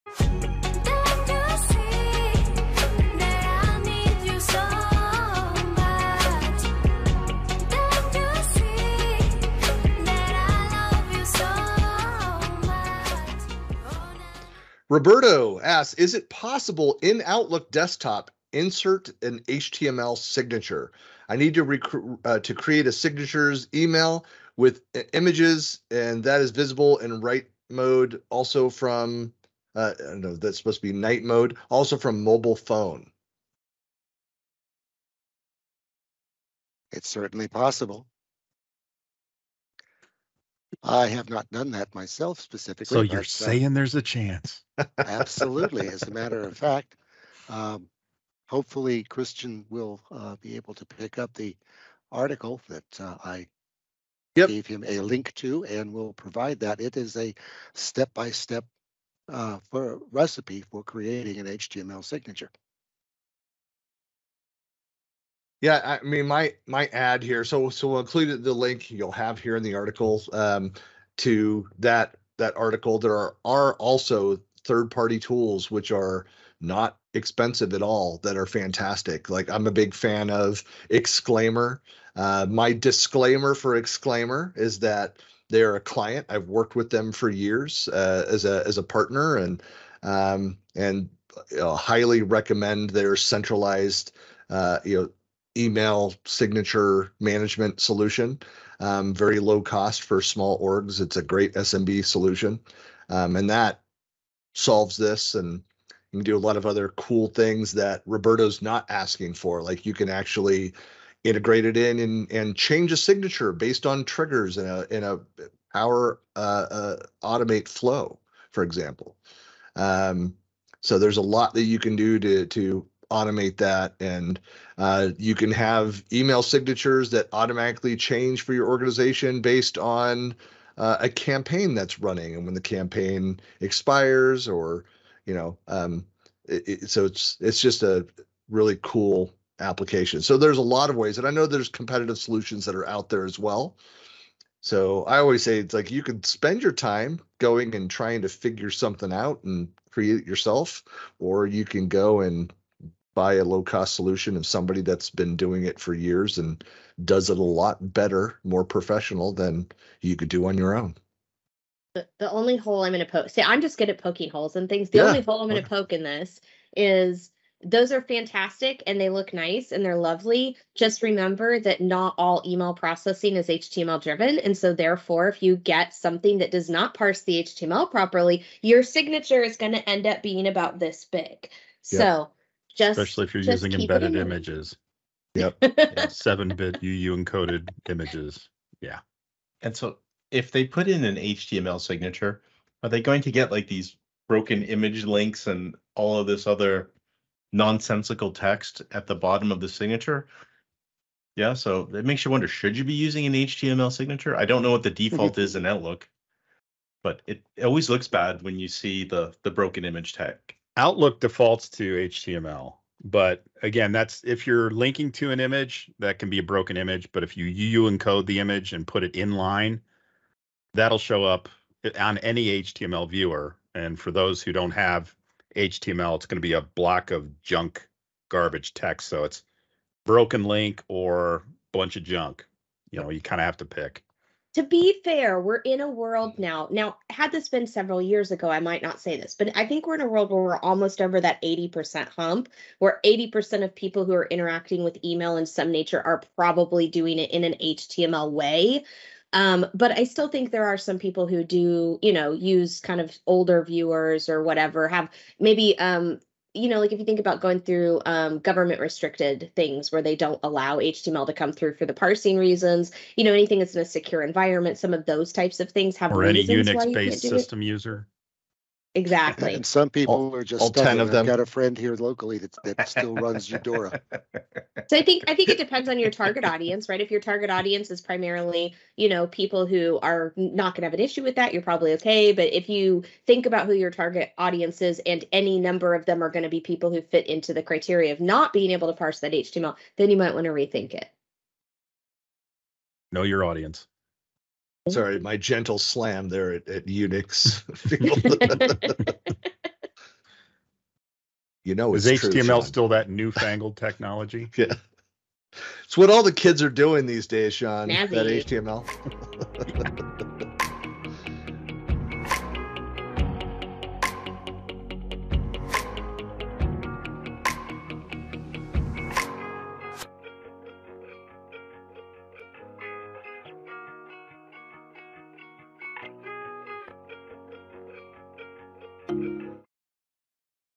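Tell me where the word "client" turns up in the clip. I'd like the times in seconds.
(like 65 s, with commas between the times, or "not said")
85 s.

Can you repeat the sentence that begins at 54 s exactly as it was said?
gave him a link to, and will provide that.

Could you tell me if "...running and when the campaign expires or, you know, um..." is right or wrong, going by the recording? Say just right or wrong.
right.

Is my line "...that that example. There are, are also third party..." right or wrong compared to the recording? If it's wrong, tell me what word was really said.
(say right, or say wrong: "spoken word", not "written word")
wrong: "article", not "example".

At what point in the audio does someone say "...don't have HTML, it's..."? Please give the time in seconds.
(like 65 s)
224 s.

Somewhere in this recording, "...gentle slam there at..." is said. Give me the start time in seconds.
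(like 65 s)
295 s.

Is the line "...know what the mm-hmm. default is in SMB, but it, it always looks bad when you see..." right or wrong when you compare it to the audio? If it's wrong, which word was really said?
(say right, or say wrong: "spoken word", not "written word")
wrong: "Outlook", not "SMB".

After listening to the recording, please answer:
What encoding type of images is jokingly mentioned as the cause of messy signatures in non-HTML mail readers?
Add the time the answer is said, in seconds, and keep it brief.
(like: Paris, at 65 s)
Seven bit UU encoded, at 186 s.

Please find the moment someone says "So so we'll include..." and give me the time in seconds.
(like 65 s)
67 s.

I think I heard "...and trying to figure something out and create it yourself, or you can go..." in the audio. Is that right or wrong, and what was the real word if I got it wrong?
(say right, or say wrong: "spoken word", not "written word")
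right.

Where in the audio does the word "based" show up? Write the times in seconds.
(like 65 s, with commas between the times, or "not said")
113 s, 129 s, 266 s.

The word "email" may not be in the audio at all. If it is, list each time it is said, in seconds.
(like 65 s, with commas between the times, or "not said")
23 s, 95 s, 126 s, 172 s, 245 s.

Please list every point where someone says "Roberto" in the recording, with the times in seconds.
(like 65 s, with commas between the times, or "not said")
14 s, 108 s.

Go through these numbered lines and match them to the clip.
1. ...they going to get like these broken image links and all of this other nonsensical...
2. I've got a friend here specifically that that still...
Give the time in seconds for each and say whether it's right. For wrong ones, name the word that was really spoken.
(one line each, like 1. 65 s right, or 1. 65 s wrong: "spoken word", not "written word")
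1. 192 s right
2. 271 s wrong: "locally", not "specifically".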